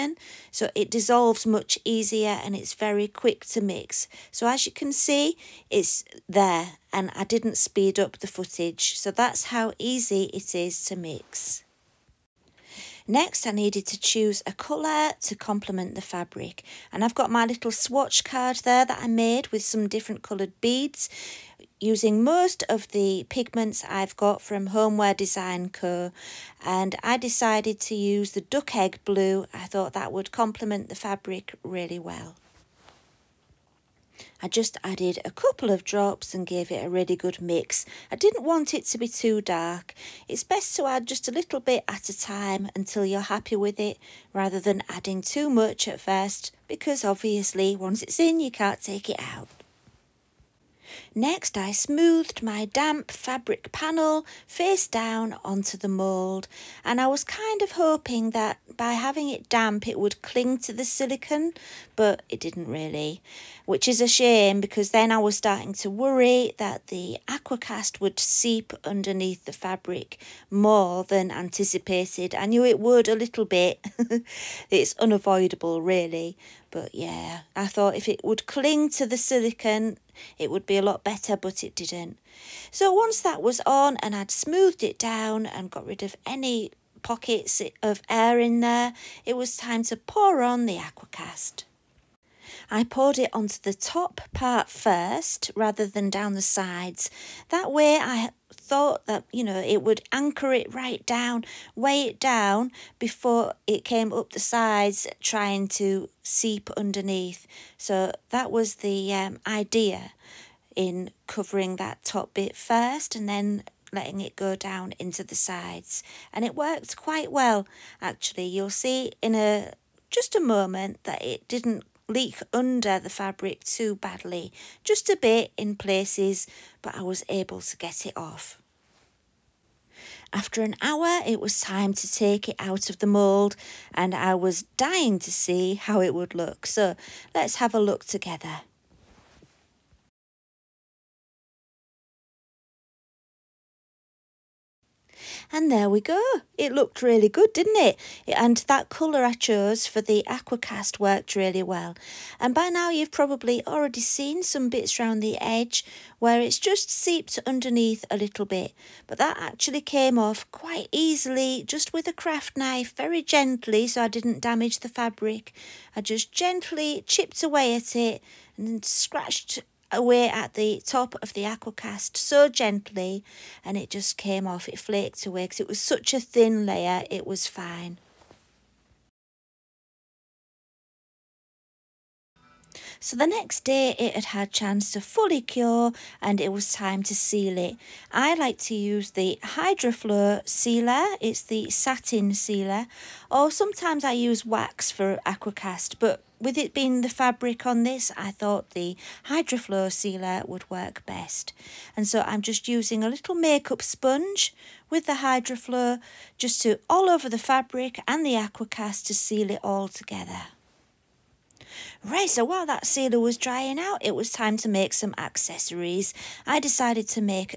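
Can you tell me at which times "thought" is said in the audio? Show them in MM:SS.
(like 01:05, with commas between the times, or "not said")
00:29, 01:17, 01:38, 03:18.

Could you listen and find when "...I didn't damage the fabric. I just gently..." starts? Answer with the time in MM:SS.
02:44.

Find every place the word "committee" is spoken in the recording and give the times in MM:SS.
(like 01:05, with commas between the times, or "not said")
not said.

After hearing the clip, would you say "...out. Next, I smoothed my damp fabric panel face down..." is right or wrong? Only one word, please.
right.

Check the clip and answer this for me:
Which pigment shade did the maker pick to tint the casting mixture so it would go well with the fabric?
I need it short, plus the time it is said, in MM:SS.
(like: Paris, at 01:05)
duck egg blue, at 00:28.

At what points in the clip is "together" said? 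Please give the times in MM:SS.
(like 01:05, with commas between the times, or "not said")
02:18, 03:29.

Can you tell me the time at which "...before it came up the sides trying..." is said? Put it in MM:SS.
01:43.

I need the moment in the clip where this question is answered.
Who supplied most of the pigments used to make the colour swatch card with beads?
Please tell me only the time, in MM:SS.
00:24.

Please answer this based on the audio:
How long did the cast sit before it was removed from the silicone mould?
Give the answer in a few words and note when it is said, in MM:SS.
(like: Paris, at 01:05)
an hour, at 02:10.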